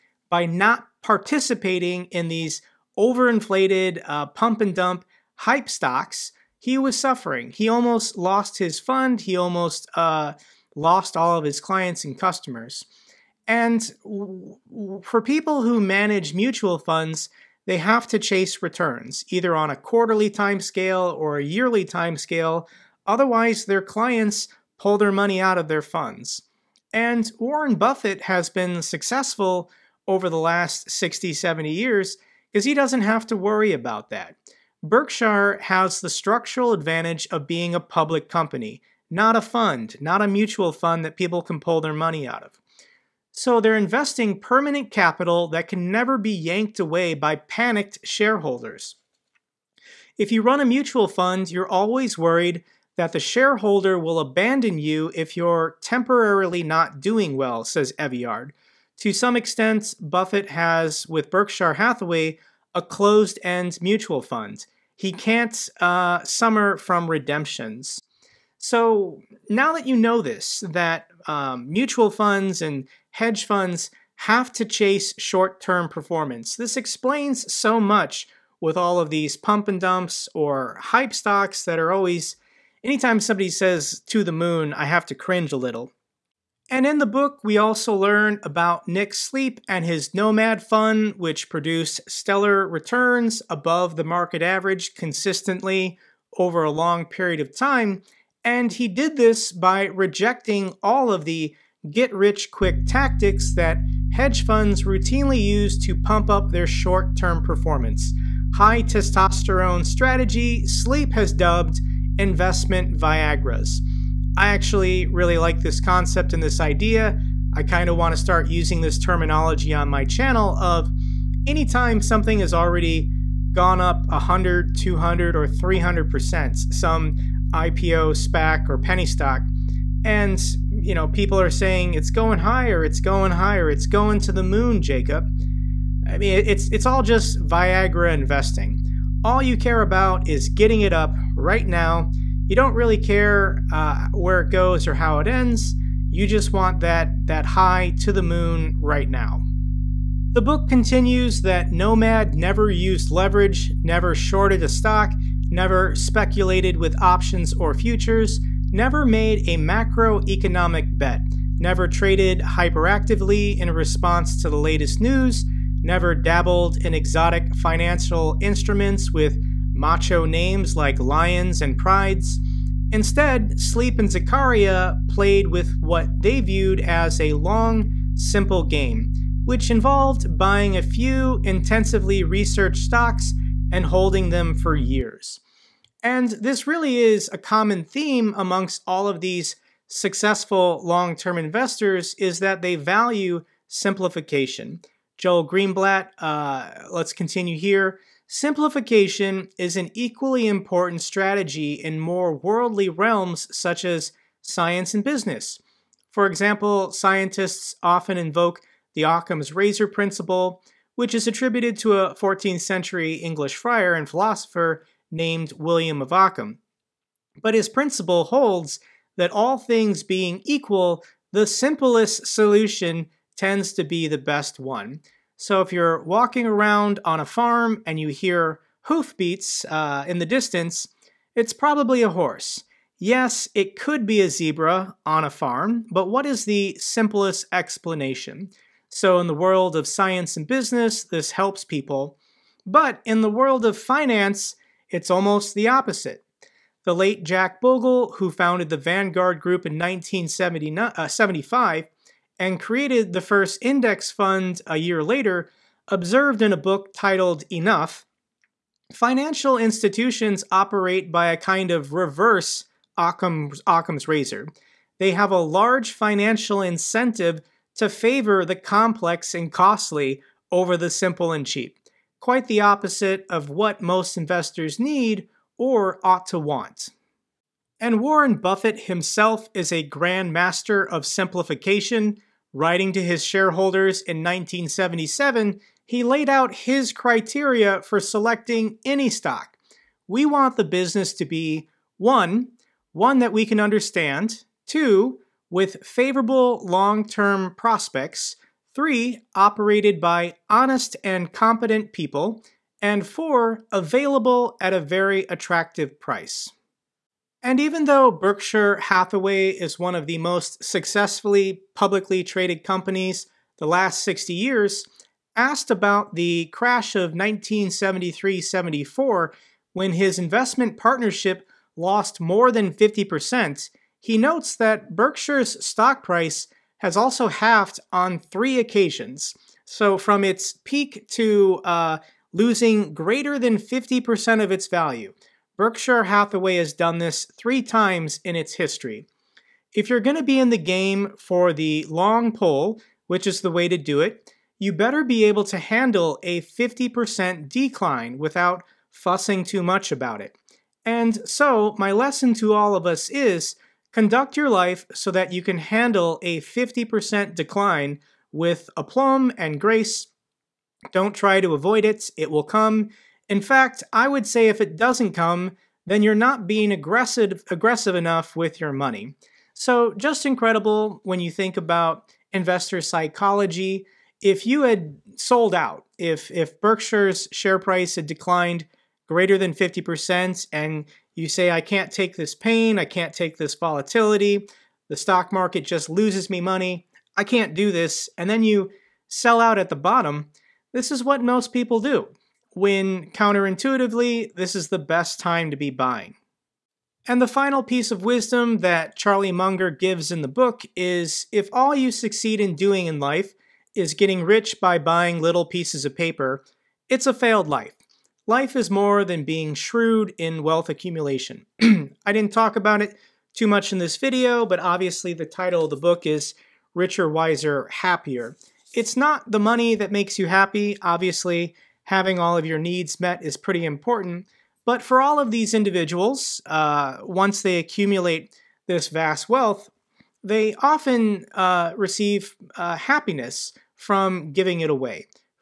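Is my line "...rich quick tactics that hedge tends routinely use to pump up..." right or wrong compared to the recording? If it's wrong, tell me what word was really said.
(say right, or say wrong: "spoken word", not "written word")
wrong: "funds", not "tends".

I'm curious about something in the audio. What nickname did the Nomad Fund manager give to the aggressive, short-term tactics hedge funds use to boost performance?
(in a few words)
investment Viagras.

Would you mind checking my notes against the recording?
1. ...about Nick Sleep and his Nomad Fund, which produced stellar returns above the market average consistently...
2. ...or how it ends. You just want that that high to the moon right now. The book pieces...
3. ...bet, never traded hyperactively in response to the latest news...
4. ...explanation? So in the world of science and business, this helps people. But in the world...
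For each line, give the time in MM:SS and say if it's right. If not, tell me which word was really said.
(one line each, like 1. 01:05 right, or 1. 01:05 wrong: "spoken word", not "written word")
1. 01:28 right
2. 02:24 wrong: "continues", not "pieces"
3. 02:40 right
4. 03:57 right.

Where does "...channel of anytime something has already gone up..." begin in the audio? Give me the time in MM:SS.
02:00.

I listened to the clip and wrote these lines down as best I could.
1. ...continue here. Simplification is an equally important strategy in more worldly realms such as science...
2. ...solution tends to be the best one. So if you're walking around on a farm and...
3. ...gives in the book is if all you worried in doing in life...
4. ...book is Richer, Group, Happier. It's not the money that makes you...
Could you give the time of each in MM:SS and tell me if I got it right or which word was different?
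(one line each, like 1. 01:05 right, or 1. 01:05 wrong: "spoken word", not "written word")
1. 03:17 right
2. 03:42 right
3. 06:39 wrong: "succeed", not "worried"
4. 06:55 wrong: "Wiser", not "Group".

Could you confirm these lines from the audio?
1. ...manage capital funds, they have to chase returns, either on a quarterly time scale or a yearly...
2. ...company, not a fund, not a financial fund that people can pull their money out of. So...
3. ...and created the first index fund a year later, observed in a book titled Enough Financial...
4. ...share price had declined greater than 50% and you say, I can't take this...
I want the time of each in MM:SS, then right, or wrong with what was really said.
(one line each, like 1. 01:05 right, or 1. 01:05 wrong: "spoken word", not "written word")
1. 00:15 wrong: "mutual", not "capital"
2. 00:38 wrong: "mutual", not "financial"
3. 04:12 right
4. 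06:17 right.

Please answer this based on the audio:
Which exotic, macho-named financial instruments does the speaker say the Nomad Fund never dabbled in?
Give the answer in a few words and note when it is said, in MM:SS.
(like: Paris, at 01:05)
lions and prides, at 02:50.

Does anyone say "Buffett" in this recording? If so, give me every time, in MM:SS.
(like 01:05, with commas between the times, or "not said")
00:27, 00:59, 04:38.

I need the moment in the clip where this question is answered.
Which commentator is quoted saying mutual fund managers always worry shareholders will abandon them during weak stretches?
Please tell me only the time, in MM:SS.
00:57.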